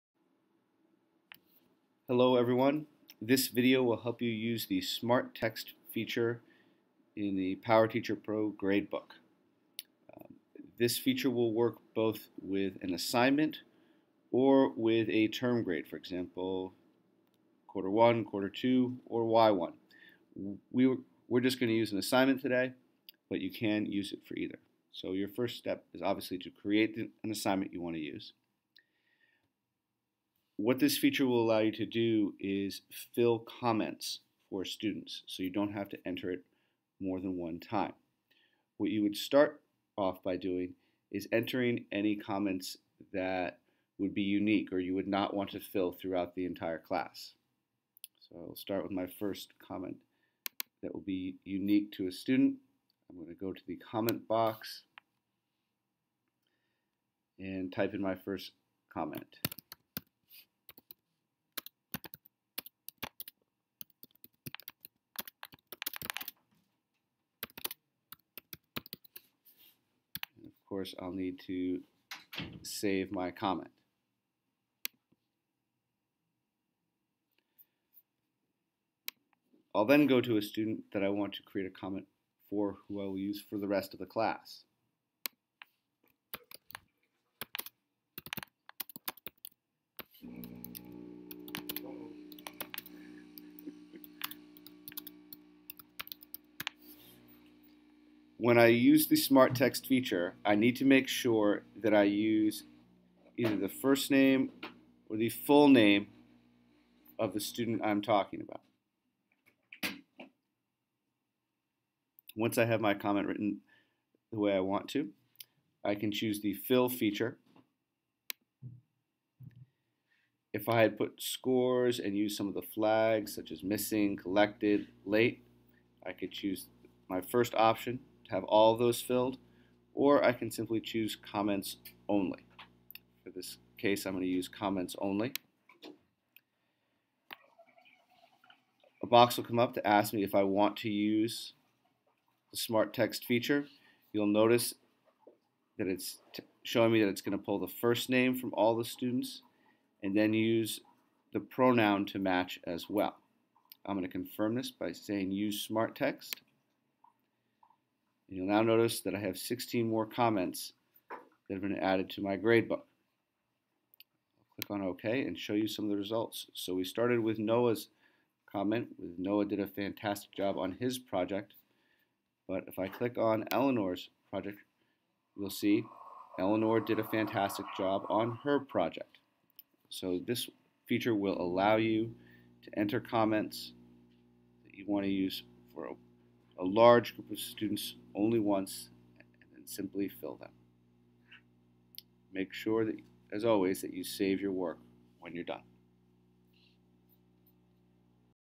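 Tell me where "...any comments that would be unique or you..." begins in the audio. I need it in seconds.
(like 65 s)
41 s.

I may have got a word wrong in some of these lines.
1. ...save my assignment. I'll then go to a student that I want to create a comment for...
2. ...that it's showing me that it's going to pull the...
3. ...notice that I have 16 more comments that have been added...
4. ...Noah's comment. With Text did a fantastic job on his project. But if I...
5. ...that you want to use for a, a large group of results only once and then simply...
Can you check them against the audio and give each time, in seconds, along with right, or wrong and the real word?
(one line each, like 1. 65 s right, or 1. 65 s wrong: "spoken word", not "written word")
1. 72 s wrong: "comment", not "assignment"
2. 145 s right
3. 158 s right
4. 167 s wrong: "Noah", not "Text"
5. 184 s wrong: "students", not "results".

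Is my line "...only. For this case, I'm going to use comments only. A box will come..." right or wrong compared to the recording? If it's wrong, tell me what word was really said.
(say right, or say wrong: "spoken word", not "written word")
right.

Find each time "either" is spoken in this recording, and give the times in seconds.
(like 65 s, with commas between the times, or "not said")
24 s, 103 s.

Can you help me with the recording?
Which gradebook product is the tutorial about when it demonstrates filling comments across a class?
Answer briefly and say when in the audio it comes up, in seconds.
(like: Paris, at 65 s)
PowerTeacher Pro, at 7 s.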